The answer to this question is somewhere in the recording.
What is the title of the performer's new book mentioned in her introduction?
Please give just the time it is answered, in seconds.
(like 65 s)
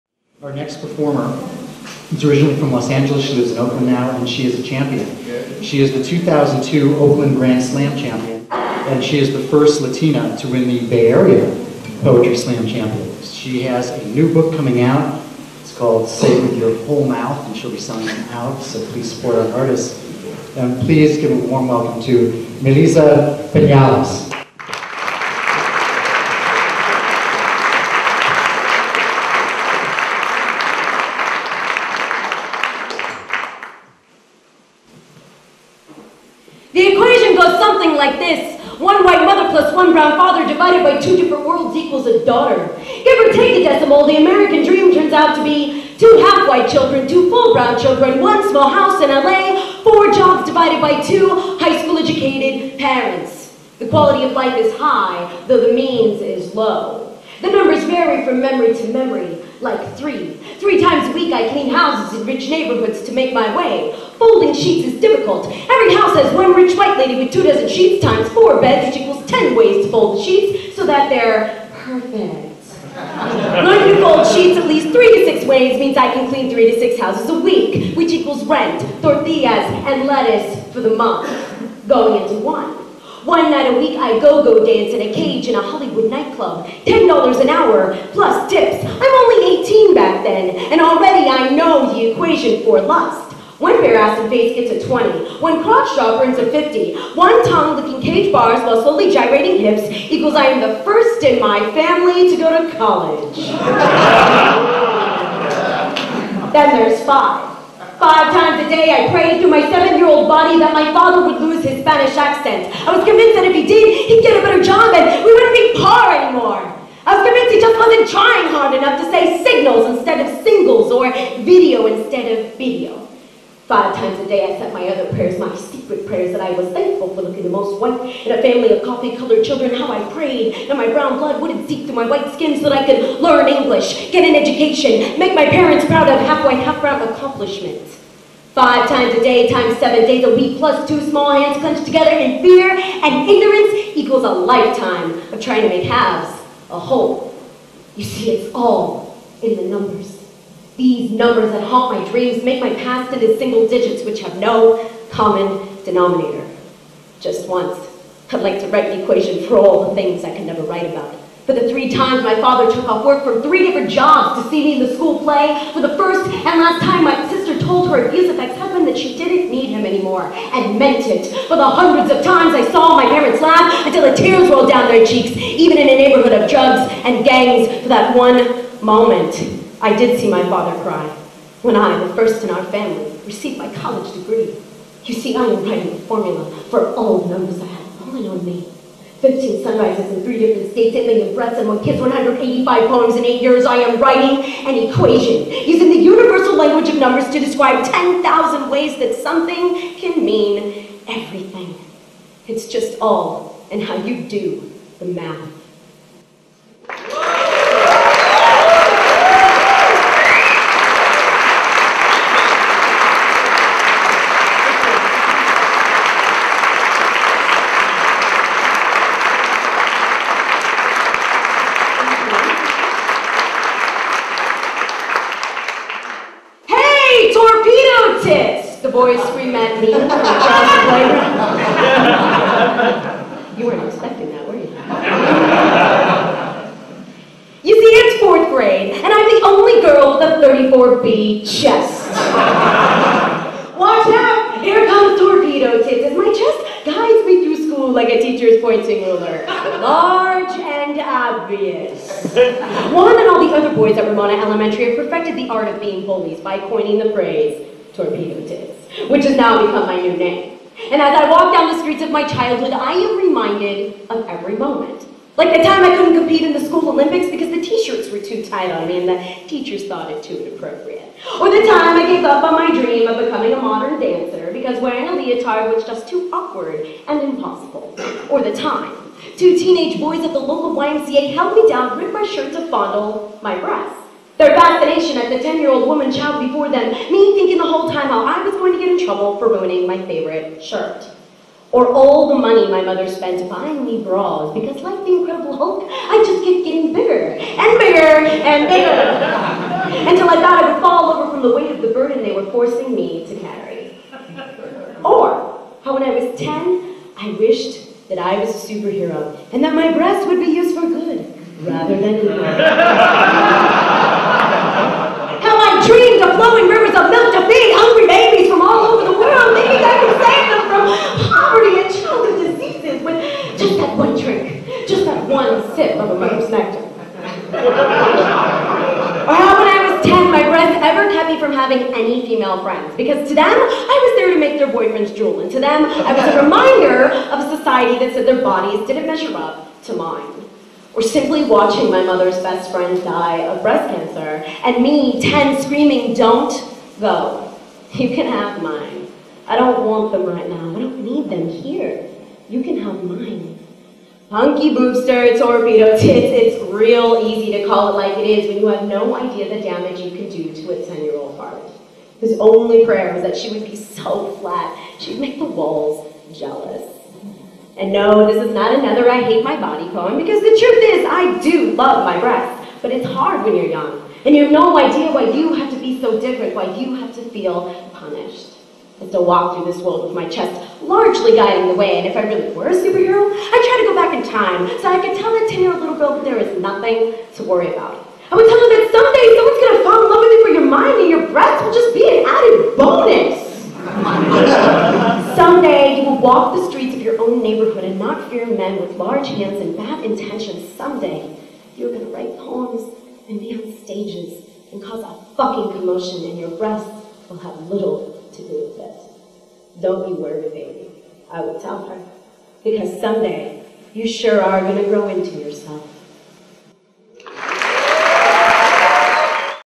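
16 s.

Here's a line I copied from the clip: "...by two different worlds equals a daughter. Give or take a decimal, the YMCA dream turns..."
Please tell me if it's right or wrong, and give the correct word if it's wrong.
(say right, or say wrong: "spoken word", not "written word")
wrong: "American", not "YMCA".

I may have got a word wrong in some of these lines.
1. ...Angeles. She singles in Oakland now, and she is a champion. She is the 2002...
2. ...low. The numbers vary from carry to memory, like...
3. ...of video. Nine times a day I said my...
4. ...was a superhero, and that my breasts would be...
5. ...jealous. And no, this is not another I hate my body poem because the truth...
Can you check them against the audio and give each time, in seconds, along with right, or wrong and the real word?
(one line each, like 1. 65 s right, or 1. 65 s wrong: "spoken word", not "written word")
1. 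2 s wrong: "lives", not "singles"
2. 56 s wrong: "memory", not "carry"
3. 122 s wrong: "Five", not "Nine"
4. 308 s right
5. 366 s right.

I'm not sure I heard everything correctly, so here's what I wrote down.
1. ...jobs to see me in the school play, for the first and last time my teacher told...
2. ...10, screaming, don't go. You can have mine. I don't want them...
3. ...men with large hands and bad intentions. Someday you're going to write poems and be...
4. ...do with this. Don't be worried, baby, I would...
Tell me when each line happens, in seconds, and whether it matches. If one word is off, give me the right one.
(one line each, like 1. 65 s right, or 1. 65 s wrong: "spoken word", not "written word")
1. 163 s wrong: "sister", not "teacher"
2. 345 s right
3. 398 s right
4. 408 s right.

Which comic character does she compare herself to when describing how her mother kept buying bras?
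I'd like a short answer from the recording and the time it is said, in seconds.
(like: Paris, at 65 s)
Incredible Hulk, at 295 s.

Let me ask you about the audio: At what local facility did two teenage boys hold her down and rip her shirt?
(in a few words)
YMCA.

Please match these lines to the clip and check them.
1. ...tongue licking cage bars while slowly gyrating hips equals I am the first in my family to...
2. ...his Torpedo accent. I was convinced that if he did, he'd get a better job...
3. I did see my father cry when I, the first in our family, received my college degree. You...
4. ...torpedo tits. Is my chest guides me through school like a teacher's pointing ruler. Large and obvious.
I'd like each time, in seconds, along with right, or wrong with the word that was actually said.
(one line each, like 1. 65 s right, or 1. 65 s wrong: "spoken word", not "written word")
1. 97 s right
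2. 111 s wrong: "Spanish", not "Torpedo"
3. 179 s right
4. 245 s right.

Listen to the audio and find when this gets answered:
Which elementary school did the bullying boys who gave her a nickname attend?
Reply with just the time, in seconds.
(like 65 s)
254 s.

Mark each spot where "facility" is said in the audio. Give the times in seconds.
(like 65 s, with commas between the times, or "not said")
not said.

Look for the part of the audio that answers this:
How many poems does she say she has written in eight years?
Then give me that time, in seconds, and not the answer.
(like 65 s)
191 s.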